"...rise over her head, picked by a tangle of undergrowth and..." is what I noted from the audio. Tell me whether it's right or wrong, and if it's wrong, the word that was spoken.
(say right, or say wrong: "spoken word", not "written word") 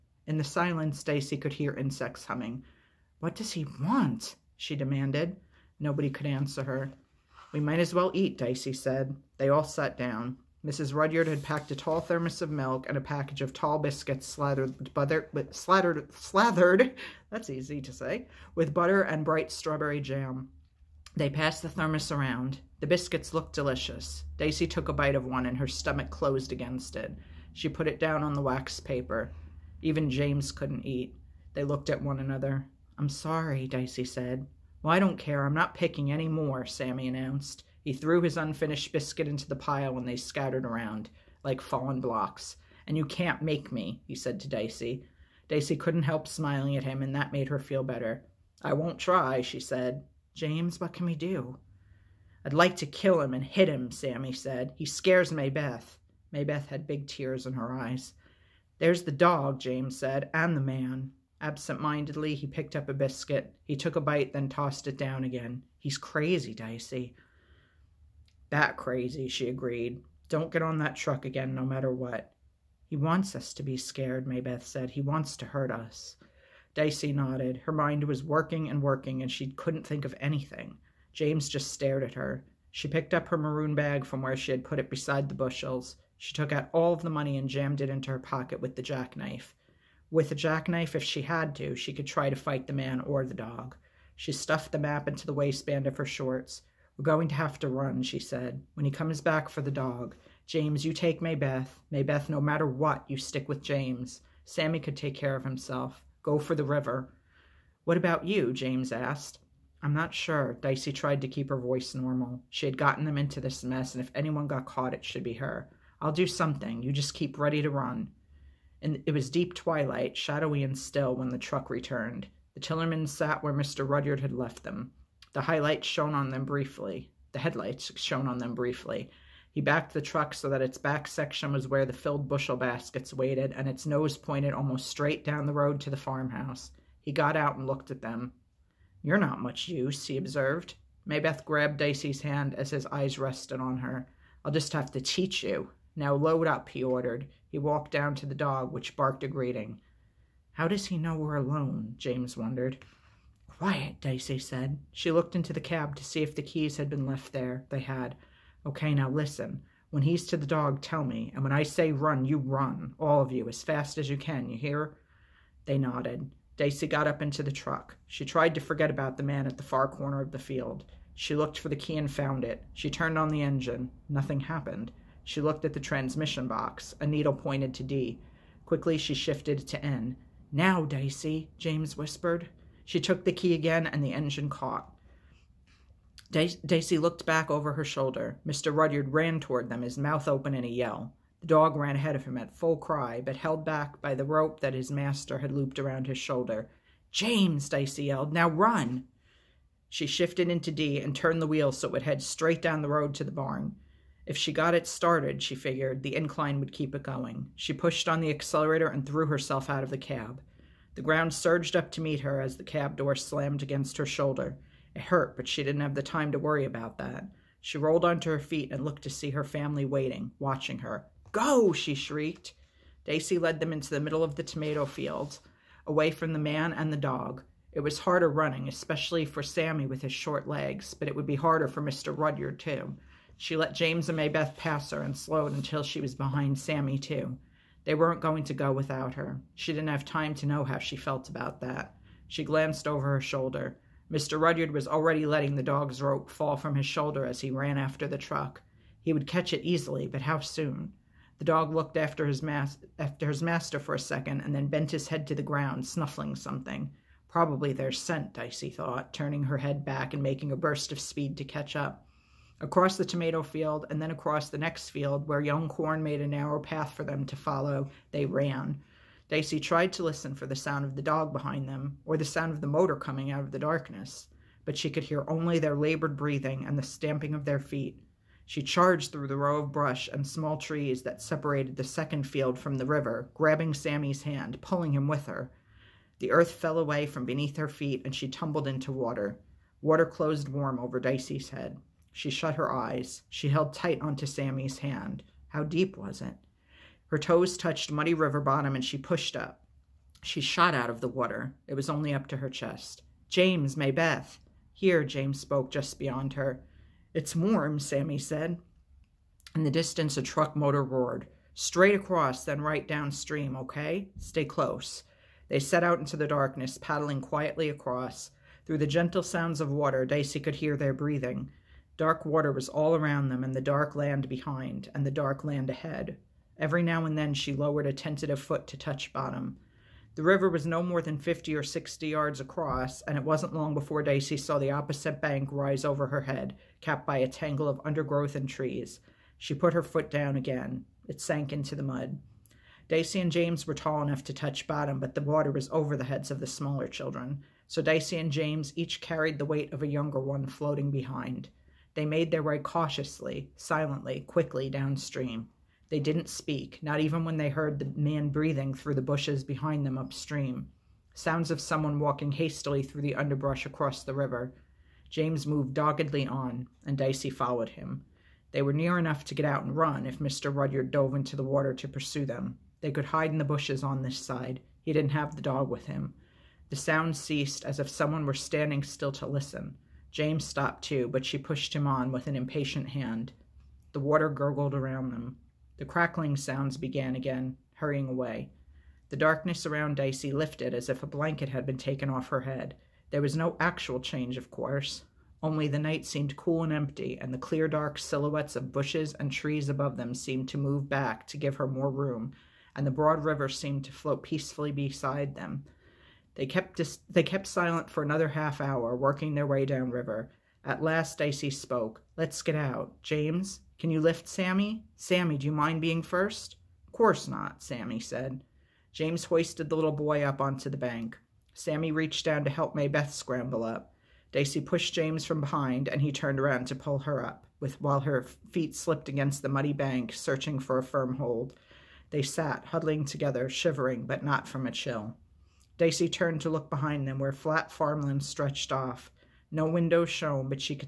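wrong: "capped", not "picked".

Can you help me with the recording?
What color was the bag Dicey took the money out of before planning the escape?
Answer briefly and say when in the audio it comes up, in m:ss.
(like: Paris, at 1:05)
maroon, at 1:23.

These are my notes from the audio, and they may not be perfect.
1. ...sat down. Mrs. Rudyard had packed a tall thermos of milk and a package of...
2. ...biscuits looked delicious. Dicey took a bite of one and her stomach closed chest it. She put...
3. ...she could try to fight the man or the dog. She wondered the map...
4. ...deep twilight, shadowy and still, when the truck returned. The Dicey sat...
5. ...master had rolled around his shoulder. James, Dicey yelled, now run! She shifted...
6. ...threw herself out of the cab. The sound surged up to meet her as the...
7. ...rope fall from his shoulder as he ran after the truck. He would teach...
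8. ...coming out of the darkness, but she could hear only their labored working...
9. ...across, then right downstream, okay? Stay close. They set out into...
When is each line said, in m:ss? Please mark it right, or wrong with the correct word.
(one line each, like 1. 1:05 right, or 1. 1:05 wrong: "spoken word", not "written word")
1. 0:09 right
2. 0:22 wrong: "against", not "chest"
3. 1:31 wrong: "stuffed", not "wondered"
4. 1:59 wrong: "Tillermans", not "Dicey"
5. 3:14 wrong: "looped", not "rolled"
6. 3:29 wrong: "ground", not "sound"
7. 4:06 wrong: "catch", not "teach"
8. 4:32 wrong: "breathing", not "working"
9. 5:11 right.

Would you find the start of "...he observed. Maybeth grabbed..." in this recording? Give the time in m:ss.
2:20.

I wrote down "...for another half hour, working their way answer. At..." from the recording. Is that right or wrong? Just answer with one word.
wrong.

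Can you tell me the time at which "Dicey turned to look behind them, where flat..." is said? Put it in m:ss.
7:15.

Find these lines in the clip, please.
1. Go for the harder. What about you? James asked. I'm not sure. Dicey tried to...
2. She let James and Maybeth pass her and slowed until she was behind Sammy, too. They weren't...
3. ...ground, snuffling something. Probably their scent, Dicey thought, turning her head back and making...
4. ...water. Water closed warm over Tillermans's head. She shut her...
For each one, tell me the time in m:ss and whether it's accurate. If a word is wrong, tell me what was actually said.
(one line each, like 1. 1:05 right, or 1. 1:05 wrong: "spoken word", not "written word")
1. 1:46 wrong: "river", not "harder"
2. 3:53 right
3. 4:15 right
4. 4:48 wrong: "Dicey", not "Tillermans".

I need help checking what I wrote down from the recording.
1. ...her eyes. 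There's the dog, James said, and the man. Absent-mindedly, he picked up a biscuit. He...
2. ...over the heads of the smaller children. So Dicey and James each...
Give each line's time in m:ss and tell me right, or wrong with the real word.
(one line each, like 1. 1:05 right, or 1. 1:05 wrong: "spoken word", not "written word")
1. 0:57 right
2. 5:45 right.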